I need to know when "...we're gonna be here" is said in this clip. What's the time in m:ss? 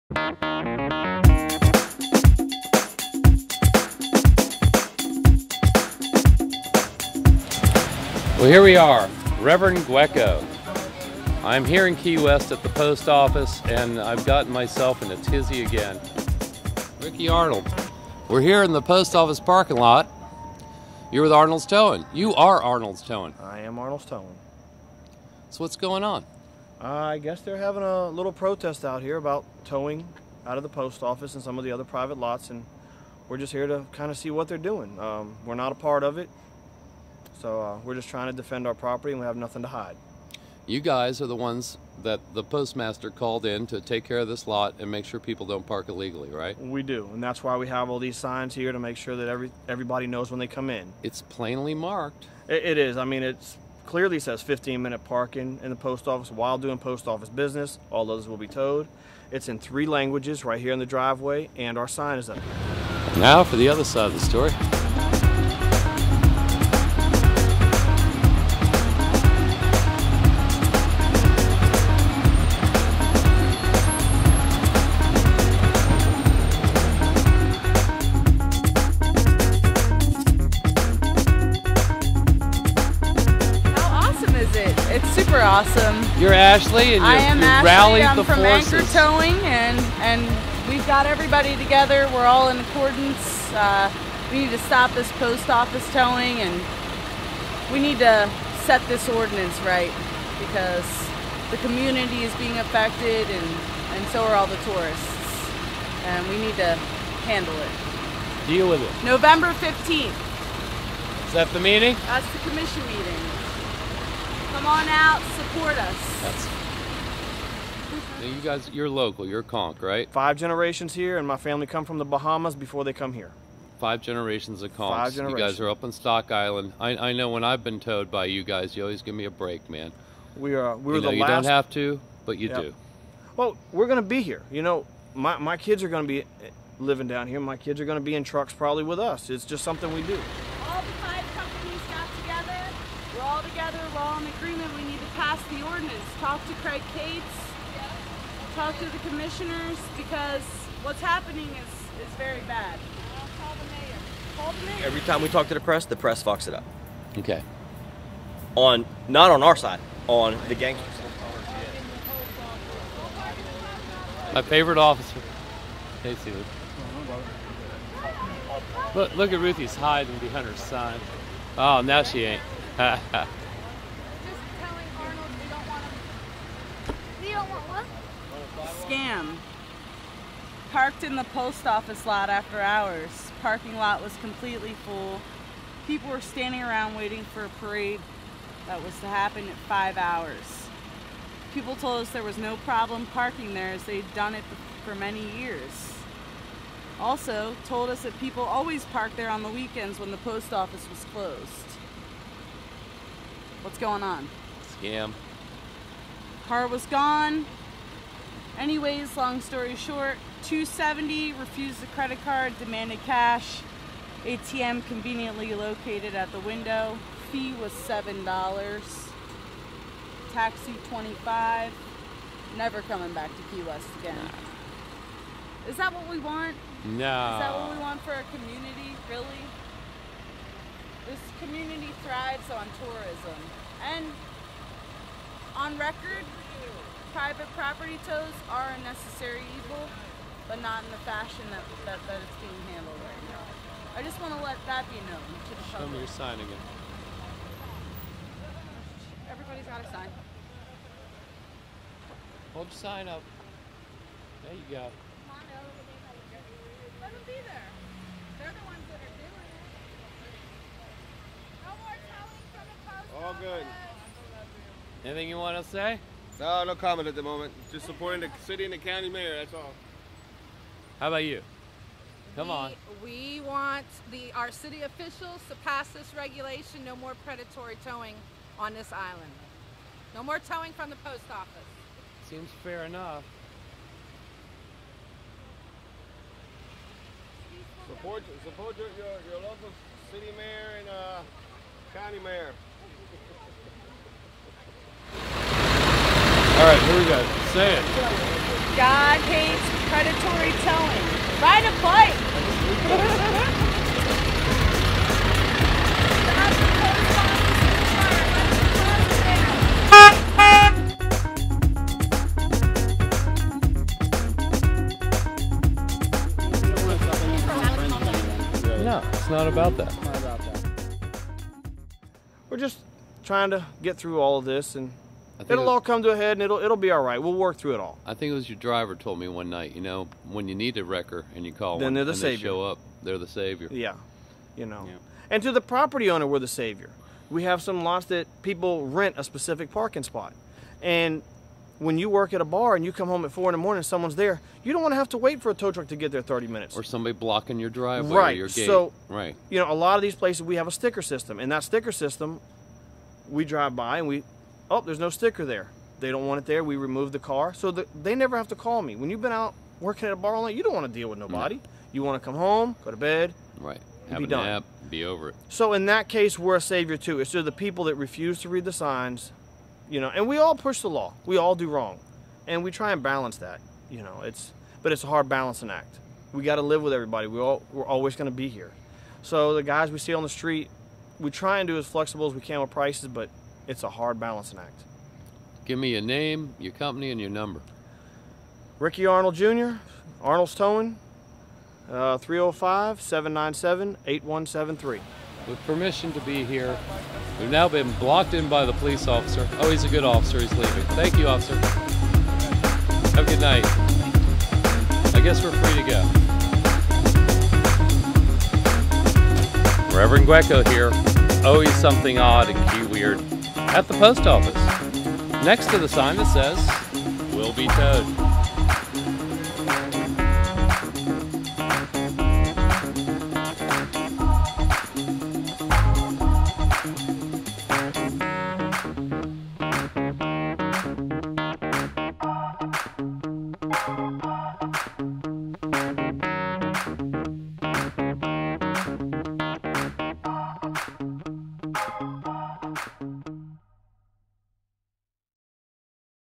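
2:13.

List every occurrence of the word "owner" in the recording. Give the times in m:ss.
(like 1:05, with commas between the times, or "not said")
5:36.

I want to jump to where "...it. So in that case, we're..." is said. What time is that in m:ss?
6:05.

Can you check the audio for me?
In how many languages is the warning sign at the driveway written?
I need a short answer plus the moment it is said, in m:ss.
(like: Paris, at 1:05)
3, at 0:59.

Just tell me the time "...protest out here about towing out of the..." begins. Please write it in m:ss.
0:28.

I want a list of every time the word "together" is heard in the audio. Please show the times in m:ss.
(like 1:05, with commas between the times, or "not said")
1:31, 2:23.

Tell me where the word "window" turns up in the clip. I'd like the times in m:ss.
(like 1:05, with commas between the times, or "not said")
3:36.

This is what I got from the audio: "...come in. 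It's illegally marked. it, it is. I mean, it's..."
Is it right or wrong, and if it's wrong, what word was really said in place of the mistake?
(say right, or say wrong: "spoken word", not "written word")
wrong: "plainly", not "illegally".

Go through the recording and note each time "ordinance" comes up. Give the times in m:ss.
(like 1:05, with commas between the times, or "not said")
1:39, 2:25.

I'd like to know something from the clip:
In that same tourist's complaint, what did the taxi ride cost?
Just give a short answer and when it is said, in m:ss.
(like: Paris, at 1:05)
25, at 3:40.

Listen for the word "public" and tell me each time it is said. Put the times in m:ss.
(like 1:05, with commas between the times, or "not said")
4:05.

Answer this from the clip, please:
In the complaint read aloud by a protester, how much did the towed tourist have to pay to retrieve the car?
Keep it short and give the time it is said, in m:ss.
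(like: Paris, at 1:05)
270, at 3:30.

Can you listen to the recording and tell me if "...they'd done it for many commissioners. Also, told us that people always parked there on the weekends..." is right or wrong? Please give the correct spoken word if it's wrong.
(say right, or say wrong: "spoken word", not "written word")
wrong: "years", not "commissioners".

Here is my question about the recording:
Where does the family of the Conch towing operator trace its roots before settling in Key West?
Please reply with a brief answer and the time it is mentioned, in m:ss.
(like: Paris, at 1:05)
The Bahamas, at 2:02.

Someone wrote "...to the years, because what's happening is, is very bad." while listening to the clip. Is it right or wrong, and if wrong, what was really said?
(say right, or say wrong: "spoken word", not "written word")
wrong: "commissioners", not "years".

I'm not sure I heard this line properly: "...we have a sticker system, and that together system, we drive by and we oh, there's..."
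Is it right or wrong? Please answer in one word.
wrong.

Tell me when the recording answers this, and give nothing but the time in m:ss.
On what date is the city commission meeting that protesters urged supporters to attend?
1:49.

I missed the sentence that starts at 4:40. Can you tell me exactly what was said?
No more towing from the post office.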